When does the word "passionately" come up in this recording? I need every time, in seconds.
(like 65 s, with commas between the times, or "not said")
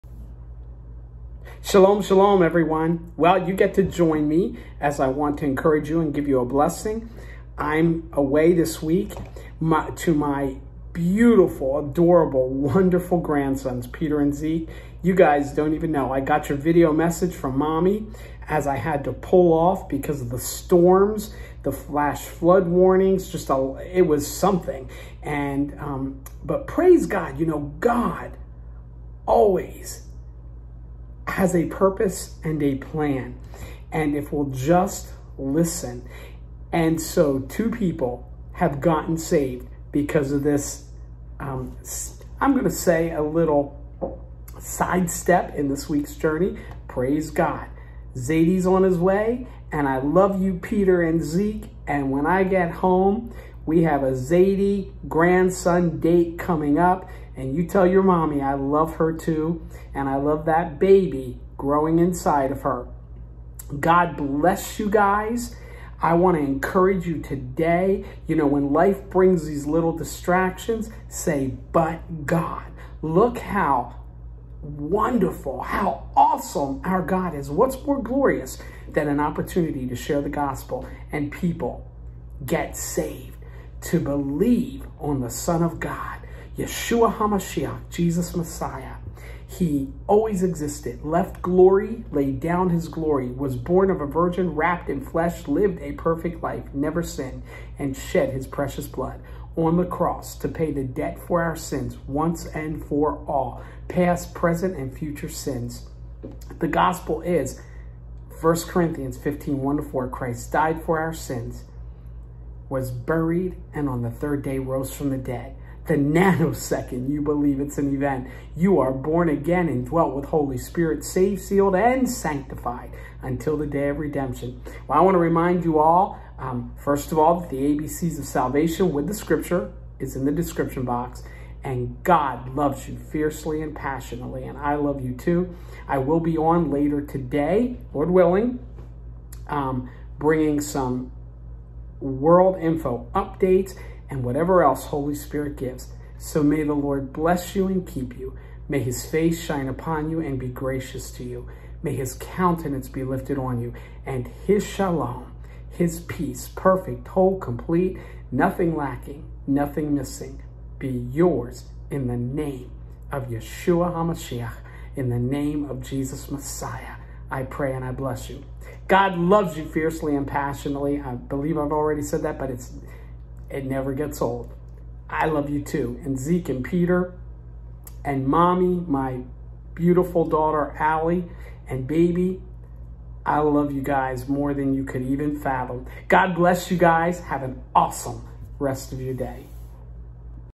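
133 s, 170 s.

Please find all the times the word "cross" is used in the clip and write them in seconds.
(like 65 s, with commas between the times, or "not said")
99 s.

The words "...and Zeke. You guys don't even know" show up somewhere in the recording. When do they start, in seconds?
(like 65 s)
14 s.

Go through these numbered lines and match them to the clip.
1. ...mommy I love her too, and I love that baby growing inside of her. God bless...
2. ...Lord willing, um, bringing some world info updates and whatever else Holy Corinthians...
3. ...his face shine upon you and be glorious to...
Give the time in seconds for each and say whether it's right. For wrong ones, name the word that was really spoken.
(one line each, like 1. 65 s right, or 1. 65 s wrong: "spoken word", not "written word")
1. 58 s right
2. 137 s wrong: "Spirit", not "Corinthians"
3. 148 s wrong: "gracious", not "glorious".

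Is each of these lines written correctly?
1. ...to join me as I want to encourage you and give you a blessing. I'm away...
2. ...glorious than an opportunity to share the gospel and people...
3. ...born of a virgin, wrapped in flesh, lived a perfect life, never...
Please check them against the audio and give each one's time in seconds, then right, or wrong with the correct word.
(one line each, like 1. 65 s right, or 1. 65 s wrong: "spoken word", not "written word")
1. 3 s right
2. 78 s right
3. 93 s right.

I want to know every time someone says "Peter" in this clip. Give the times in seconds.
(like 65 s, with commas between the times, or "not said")
13 s, 50 s, 176 s.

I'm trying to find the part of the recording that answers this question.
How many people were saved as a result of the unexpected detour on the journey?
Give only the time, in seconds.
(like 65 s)
37 s.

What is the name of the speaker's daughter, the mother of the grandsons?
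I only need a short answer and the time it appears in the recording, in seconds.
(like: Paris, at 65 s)
Allie, at 180 s.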